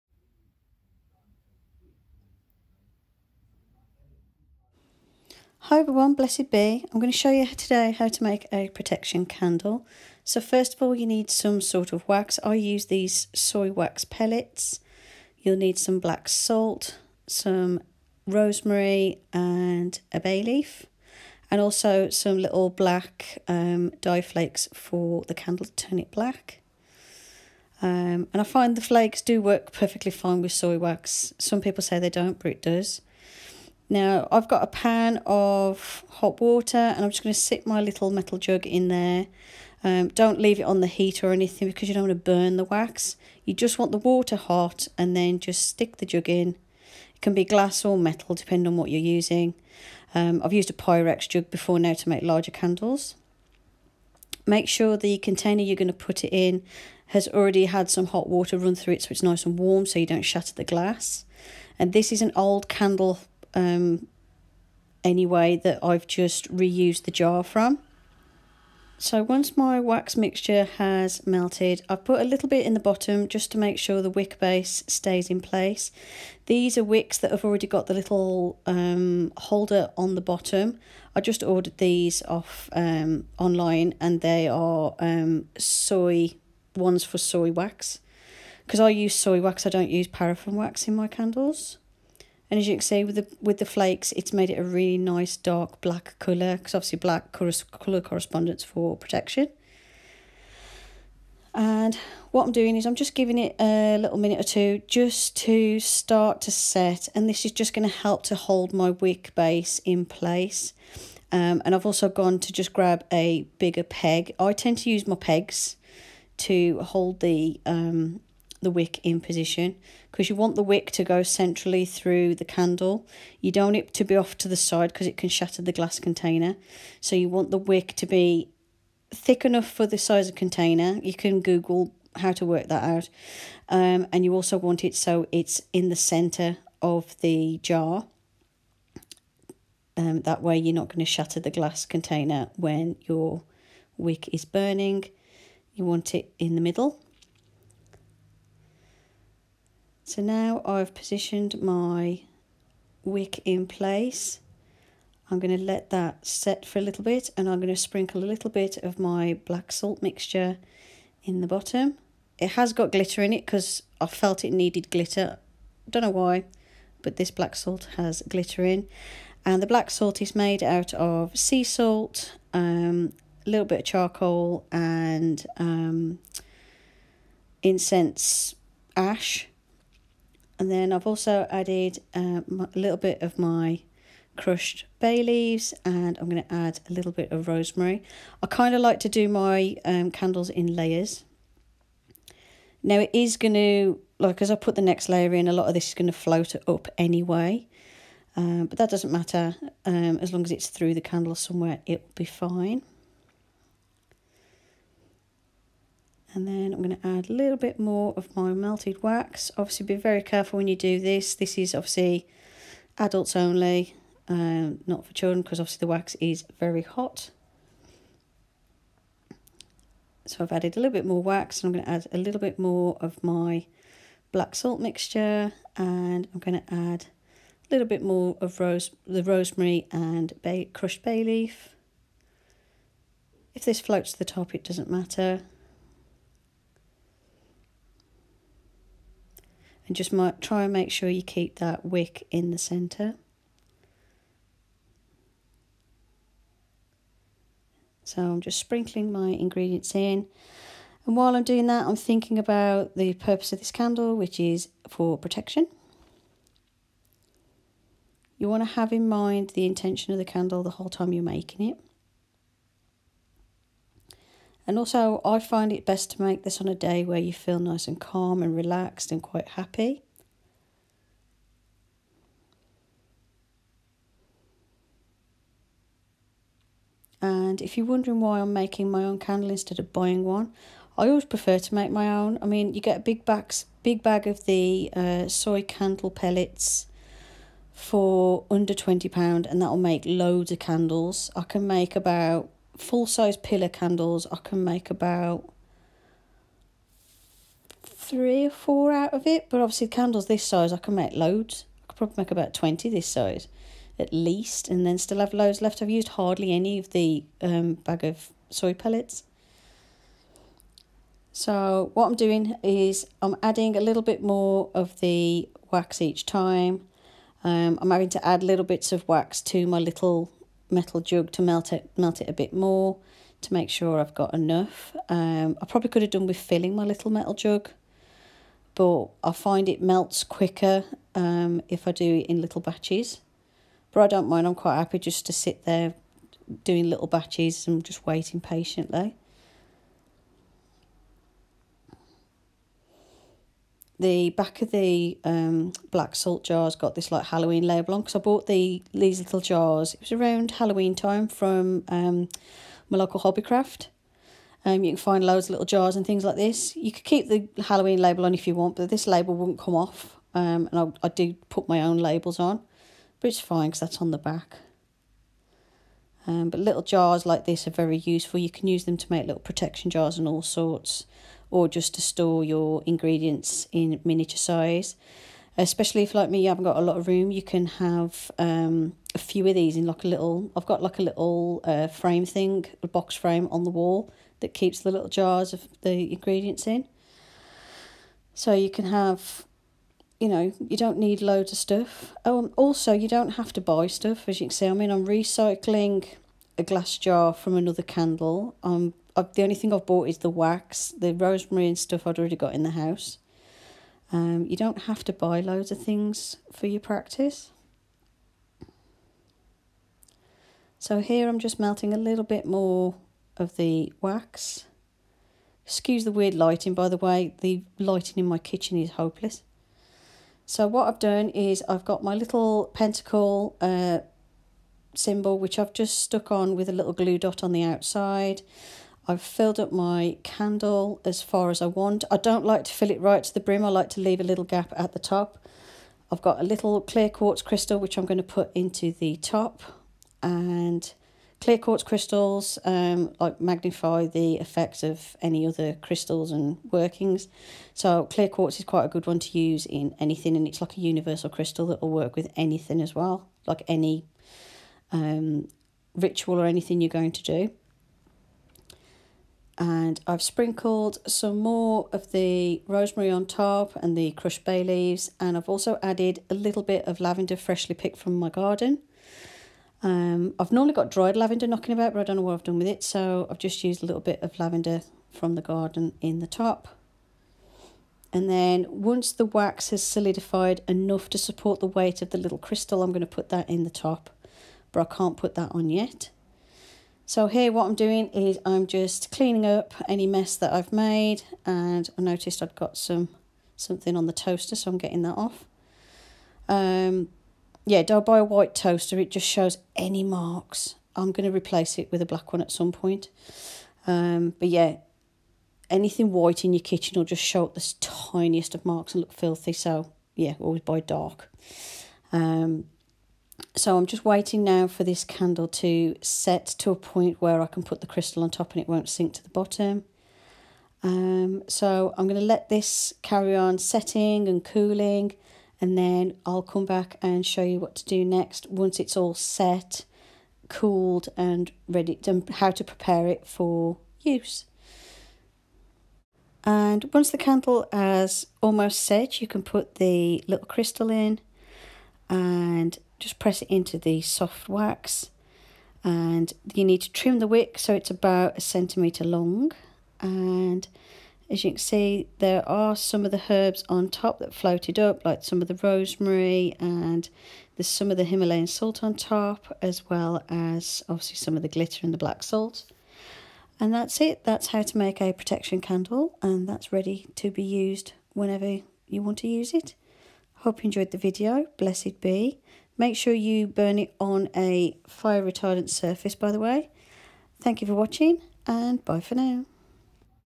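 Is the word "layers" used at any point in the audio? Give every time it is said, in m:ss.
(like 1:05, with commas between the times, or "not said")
3:10, 3:15.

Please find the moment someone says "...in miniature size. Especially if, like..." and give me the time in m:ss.
6:13.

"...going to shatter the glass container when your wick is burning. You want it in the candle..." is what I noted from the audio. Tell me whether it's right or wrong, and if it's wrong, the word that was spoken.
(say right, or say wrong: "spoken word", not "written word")
wrong: "middle", not "candle".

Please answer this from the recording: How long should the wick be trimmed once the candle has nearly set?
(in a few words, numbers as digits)
1 centimeter.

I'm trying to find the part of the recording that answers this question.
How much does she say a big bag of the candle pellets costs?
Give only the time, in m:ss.
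4:48.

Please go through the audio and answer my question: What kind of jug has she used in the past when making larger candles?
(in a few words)
Pyrex jug.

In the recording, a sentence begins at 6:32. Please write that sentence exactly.
Um, also, you don't have to buy stuff, as you can see.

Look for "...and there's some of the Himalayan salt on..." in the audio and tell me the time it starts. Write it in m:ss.
9:16.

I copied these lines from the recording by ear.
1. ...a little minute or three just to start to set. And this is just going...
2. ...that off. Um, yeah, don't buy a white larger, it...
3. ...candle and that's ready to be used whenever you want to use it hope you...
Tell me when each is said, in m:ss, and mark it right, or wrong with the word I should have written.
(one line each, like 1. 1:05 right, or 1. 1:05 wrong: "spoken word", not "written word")
1. 1:43 wrong: "two", not "three"
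2. 8:15 wrong: "toaster", not "larger"
3. 9:25 right.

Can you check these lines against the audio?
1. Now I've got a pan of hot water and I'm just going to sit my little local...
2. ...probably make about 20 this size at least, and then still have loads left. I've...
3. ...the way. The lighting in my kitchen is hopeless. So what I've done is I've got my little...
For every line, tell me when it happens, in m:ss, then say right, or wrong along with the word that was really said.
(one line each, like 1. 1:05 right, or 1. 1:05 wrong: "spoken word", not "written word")
1. 0:33 wrong: "metal", not "local"
2. 5:01 right
3. 6:56 right.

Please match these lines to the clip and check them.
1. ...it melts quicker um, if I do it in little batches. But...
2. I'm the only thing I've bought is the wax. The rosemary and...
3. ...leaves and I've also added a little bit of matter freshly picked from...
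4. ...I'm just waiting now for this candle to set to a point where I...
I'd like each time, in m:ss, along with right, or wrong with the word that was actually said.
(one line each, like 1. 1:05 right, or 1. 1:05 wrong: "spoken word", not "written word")
1. 5:29 right
2. 6:38 right
3. 7:44 wrong: "lavender", not "matter"
4. 8:33 right.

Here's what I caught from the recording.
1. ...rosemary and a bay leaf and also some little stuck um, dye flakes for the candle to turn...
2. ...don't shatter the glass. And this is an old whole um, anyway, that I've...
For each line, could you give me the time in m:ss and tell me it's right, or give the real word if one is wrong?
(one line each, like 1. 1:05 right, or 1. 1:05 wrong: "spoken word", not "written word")
1. 0:18 wrong: "black", not "stuck"
2. 1:00 wrong: "candle", not "whole".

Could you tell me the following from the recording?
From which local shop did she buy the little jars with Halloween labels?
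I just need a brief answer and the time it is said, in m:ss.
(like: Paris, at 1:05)
Hobbycraft, at 5:53.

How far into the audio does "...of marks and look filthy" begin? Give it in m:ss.
8:28.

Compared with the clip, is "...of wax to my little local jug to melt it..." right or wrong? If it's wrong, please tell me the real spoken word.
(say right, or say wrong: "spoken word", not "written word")
wrong: "metal", not "local".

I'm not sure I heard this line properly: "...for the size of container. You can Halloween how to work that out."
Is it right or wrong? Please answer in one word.
wrong.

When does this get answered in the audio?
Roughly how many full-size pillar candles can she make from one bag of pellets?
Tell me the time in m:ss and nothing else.
4:57.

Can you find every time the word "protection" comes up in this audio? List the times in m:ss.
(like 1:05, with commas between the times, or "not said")
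0:08, 1:38, 4:15, 6:09, 9:25.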